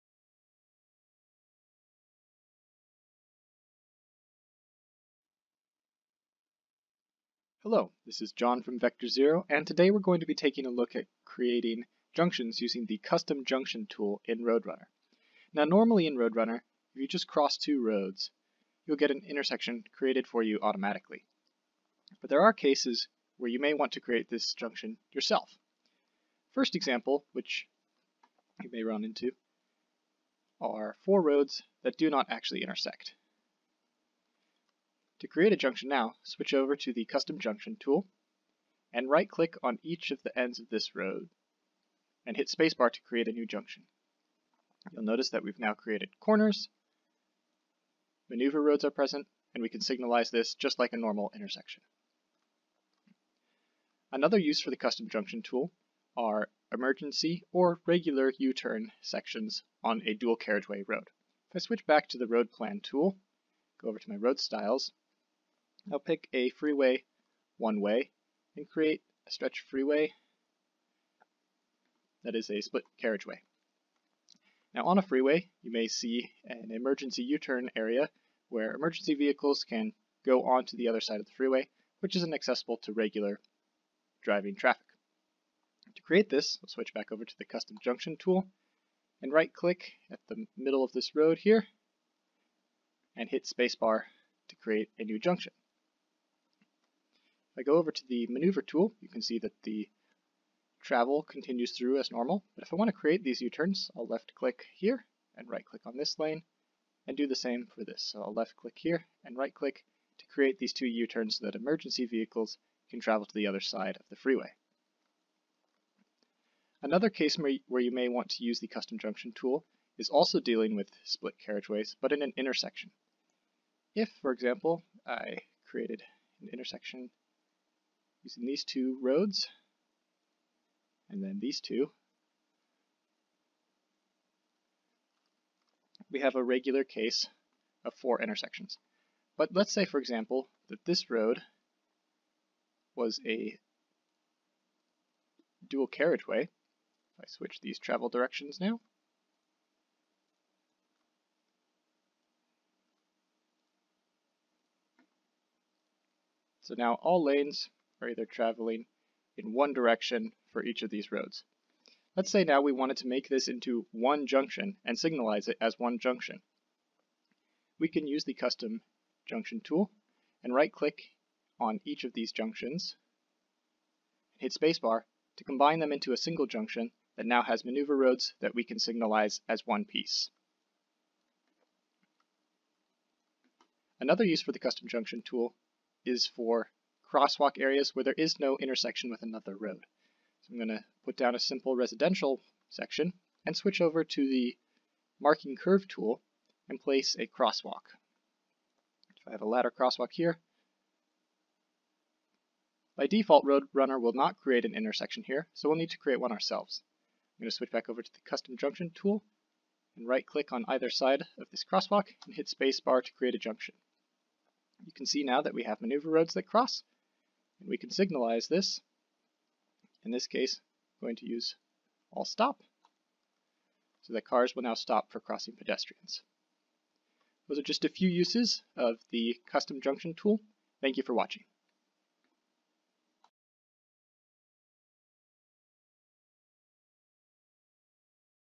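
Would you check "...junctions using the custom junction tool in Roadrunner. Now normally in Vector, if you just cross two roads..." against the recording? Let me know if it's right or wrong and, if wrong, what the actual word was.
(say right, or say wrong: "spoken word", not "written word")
wrong: "Roadrunner", not "Vector".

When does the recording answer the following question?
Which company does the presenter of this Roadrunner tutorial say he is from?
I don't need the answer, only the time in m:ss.
0:08.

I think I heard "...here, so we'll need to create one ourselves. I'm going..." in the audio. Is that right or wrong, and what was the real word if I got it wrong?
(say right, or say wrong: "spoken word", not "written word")
right.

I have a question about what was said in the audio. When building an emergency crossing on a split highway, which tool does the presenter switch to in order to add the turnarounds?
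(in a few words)
maneuver tool.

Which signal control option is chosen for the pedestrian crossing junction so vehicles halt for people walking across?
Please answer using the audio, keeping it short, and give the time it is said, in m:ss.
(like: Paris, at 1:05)
all stop, at 3:42.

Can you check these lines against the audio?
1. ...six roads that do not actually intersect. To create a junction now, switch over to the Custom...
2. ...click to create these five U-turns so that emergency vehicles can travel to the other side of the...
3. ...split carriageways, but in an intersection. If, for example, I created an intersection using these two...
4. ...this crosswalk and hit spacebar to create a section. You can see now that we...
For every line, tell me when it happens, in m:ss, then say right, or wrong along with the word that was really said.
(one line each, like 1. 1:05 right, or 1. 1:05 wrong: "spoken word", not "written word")
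1. 0:31 wrong: "four", not "six"
2. 1:49 wrong: "two", not "five"
3. 2:01 right
4. 3:31 wrong: "junction", not "section".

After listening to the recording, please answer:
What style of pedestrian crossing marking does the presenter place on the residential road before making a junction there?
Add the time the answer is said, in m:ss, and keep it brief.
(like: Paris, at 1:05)
ladder crosswalk, at 3:19.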